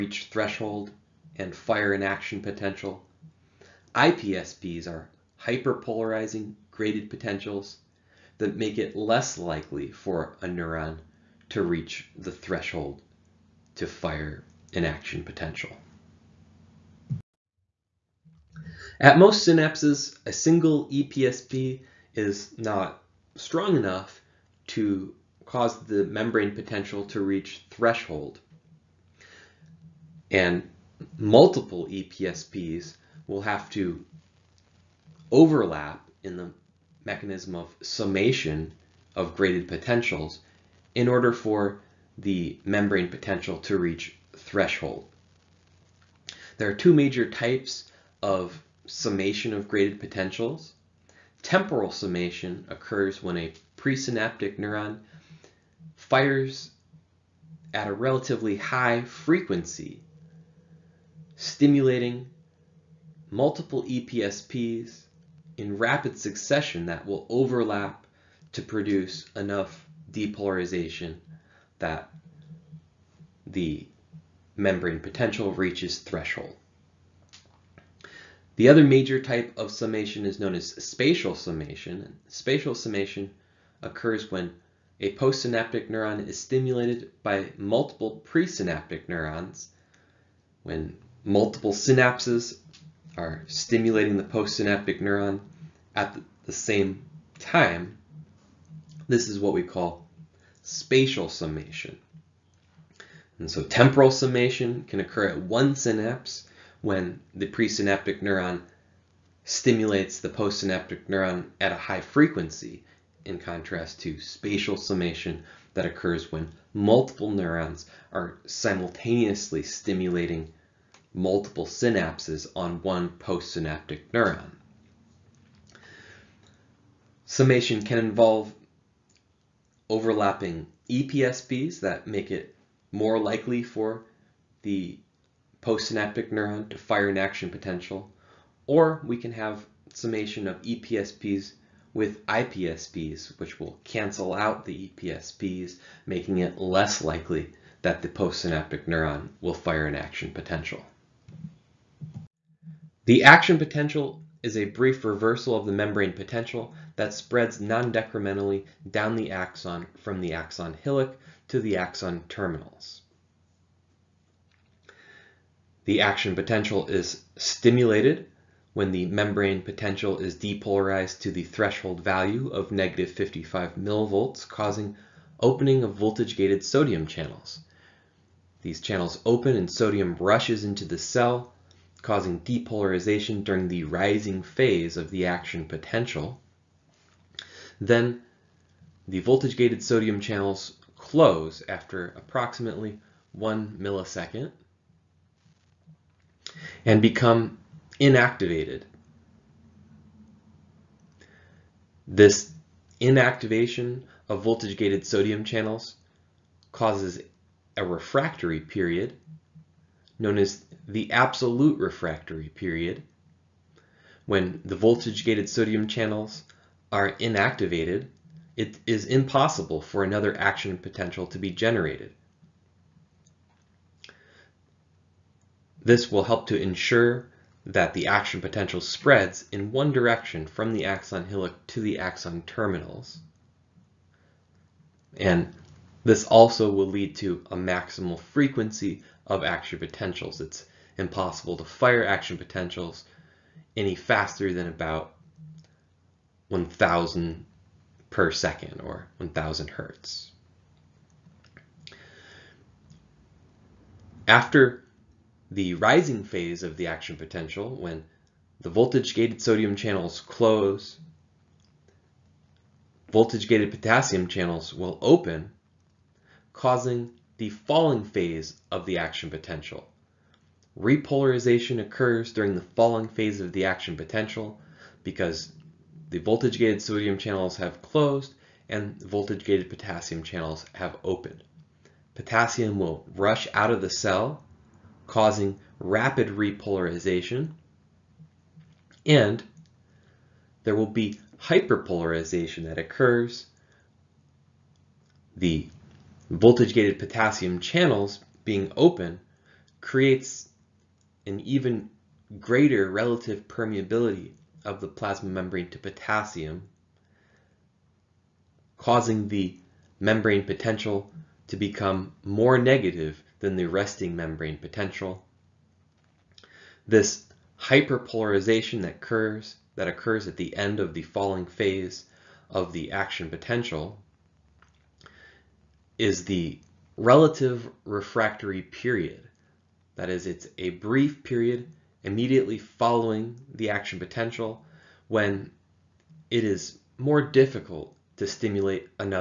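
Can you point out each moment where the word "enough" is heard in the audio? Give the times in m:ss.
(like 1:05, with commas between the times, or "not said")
0:23, 1:09.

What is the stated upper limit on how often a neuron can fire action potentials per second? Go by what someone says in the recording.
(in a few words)
1000 hertz.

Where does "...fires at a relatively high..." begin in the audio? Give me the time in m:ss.
0:55.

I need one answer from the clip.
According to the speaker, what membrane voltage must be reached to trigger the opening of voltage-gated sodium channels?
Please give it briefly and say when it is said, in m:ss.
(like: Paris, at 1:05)
-55 millivolts, at 2:52.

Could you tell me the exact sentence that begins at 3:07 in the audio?
Then the voltage-gated sodium channels close after approximately one millisecond and become inactivated.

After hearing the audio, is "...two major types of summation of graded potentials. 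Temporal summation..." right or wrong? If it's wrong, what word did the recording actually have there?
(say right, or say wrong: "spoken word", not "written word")
right.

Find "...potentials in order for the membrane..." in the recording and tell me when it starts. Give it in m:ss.
0:39.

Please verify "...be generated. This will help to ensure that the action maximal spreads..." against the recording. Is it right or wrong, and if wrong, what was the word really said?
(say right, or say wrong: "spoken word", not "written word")
wrong: "potential", not "maximal".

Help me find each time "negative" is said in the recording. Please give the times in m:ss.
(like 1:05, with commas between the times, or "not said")
2:52, 5:12.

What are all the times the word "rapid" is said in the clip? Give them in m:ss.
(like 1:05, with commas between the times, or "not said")
1:05, 4:45.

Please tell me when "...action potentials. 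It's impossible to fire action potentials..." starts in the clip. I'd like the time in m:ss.
3:59.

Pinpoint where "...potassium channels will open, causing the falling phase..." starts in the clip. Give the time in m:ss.
4:23.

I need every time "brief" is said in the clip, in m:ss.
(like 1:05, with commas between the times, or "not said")
2:34, 5:30.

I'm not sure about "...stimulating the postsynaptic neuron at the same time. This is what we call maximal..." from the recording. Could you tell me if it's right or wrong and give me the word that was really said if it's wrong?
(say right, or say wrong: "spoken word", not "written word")
wrong: "spatial", not "maximal".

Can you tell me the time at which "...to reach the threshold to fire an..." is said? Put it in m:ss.
0:11.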